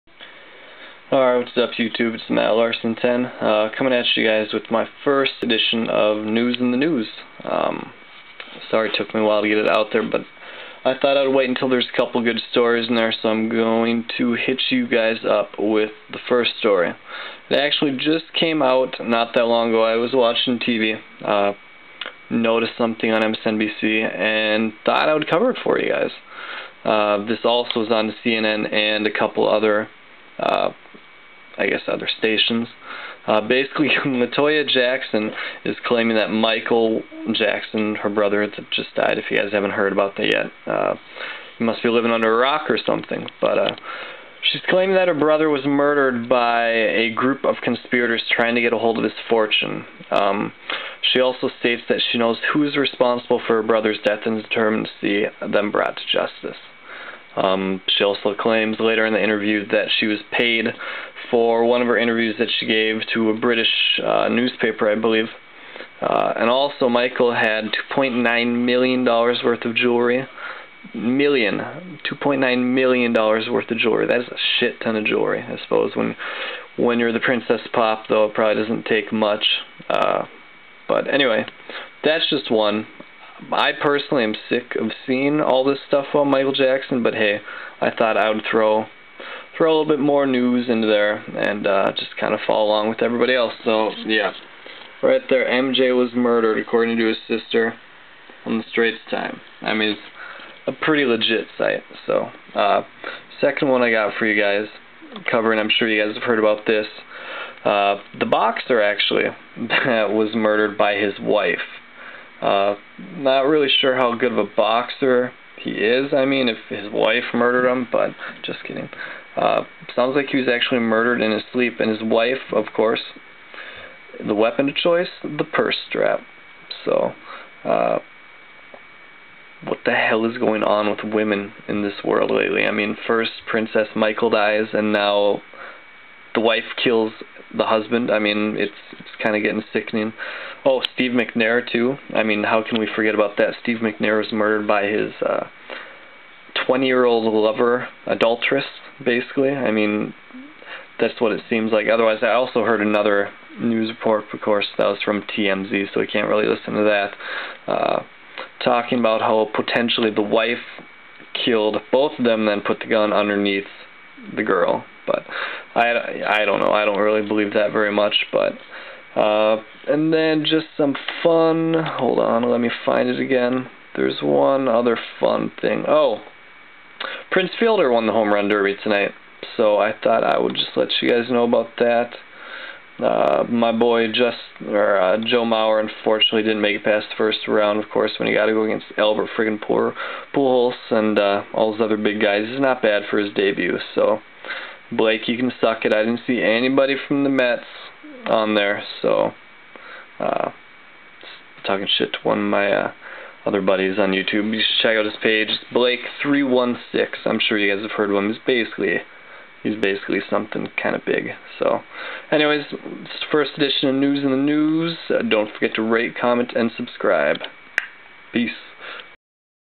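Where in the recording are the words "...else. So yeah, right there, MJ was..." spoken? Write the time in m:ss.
1:33.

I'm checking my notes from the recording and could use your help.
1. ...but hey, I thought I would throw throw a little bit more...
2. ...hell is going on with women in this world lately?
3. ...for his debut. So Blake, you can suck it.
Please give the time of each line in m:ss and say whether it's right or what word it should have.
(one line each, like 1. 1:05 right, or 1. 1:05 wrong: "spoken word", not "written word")
1. 1:27 right
2. 2:09 right
3. 3:13 right.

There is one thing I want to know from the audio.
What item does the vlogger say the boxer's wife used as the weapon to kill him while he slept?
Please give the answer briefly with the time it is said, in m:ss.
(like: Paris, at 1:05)
purse strap, at 2:05.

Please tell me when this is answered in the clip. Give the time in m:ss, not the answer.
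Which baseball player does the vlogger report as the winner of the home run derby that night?
2:57.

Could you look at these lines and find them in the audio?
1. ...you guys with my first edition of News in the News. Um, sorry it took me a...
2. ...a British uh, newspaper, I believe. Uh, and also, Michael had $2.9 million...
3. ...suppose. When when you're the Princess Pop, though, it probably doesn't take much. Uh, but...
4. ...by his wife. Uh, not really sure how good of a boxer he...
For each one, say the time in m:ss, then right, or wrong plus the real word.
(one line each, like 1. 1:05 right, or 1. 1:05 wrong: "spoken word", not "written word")
1. 0:04 right
2. 1:03 right
3. 1:15 right
4. 1:50 right.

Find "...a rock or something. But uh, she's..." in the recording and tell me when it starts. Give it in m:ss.
0:42.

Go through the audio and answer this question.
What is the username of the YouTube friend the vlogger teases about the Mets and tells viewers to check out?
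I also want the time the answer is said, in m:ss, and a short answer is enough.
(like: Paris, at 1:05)
Blake316, at 3:25.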